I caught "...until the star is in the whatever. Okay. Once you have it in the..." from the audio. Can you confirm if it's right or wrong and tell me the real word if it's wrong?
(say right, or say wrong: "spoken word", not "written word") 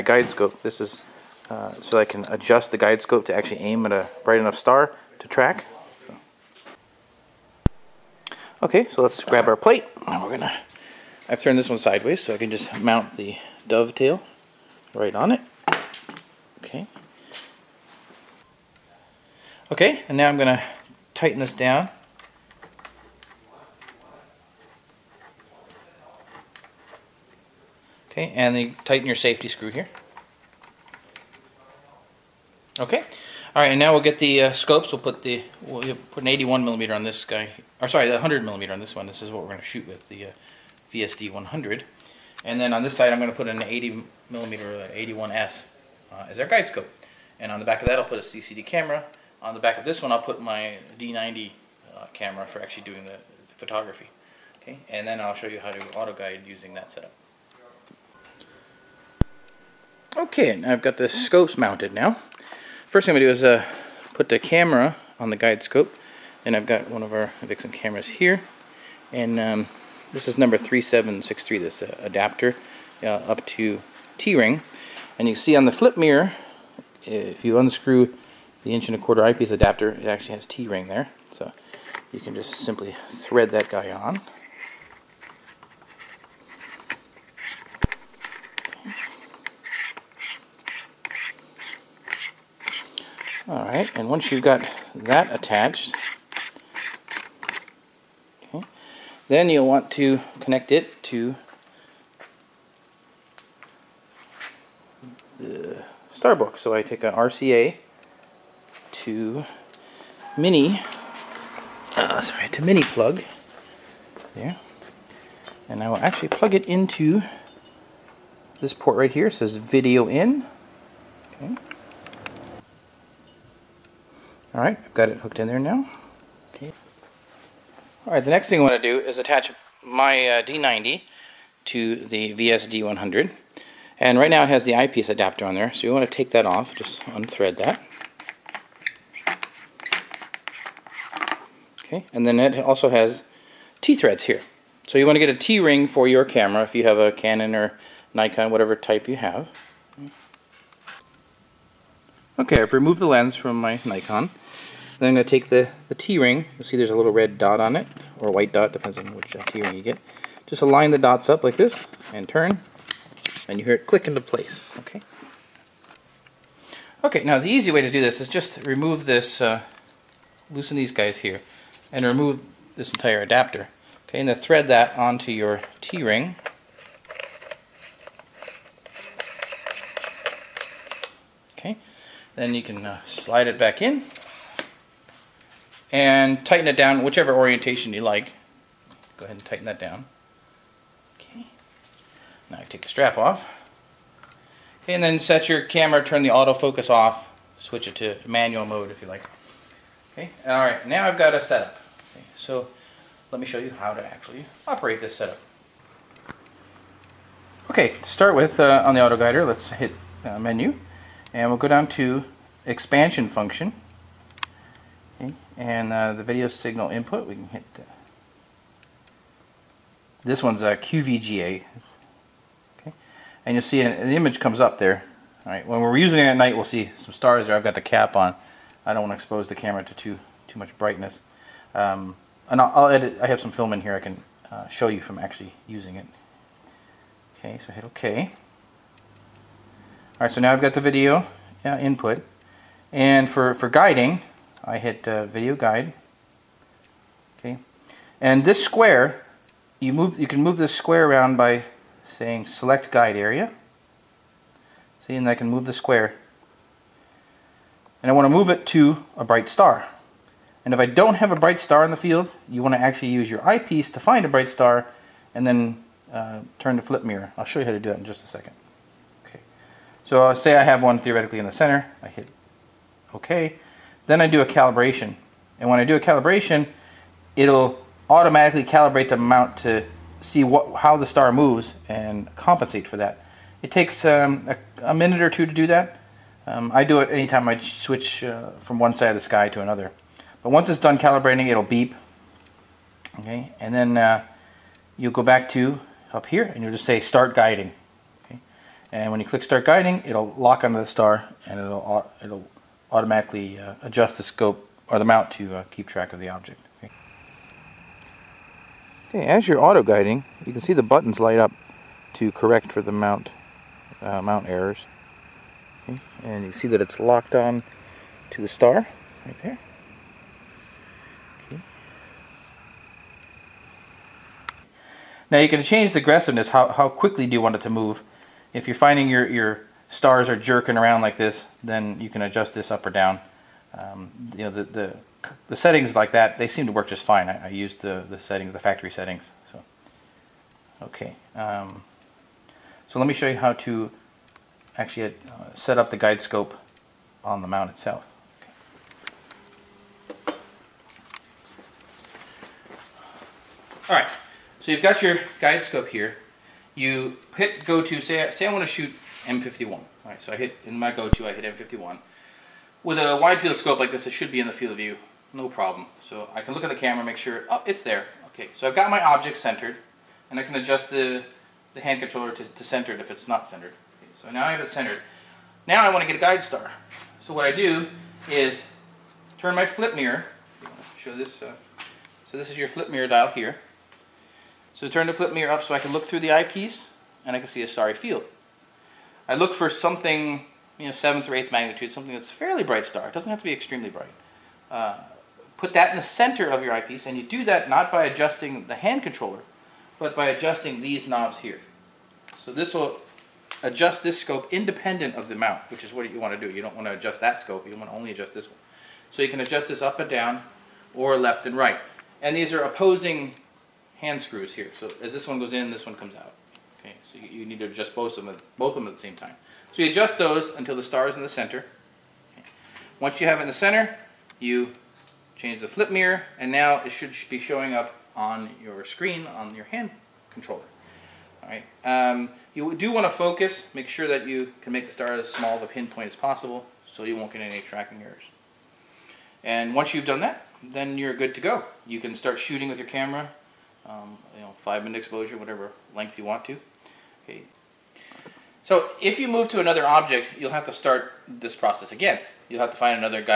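wrong: "center", not "whatever".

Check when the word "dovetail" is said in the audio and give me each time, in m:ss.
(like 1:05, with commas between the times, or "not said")
0:13.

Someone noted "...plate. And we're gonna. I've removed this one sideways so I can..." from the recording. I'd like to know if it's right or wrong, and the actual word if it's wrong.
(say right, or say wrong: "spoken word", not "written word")
wrong: "turned", not "removed".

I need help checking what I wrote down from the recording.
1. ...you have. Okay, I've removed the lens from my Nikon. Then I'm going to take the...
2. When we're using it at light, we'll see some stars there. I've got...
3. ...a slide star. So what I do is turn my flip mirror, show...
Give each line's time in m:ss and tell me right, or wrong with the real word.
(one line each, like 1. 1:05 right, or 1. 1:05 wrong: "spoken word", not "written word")
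1. 2:29 right
2. 3:45 wrong: "night", not "light"
3. 6:16 wrong: "guide", not "slide".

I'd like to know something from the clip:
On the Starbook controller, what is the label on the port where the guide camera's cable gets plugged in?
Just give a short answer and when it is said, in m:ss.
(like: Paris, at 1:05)
Video in, at 1:59.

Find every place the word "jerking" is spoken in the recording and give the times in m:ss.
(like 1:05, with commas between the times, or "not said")
5:30.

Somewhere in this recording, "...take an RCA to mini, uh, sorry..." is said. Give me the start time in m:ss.
1:46.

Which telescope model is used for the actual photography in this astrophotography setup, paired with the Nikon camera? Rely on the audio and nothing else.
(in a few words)
VSD 100.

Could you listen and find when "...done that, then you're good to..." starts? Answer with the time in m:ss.
7:20.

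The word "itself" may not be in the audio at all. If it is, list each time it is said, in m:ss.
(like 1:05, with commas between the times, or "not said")
5:47.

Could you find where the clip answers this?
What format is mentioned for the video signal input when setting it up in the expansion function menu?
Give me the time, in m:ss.
3:40.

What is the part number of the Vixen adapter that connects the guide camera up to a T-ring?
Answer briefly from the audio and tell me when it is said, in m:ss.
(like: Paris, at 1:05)
3763, at 1:10.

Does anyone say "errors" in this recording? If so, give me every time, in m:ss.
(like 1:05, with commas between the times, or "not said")
5:14, 7:18.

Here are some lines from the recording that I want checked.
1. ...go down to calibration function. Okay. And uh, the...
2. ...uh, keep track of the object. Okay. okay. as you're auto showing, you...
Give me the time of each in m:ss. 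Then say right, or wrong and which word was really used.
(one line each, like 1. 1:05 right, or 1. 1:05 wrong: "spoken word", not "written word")
1. 3:31 wrong: "expansion", not "calibration"
2. 5:05 wrong: "guiding", not "showing".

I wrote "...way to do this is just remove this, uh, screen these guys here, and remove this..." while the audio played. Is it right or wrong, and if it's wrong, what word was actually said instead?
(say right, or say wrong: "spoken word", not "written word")
wrong: "loosen", not "screen".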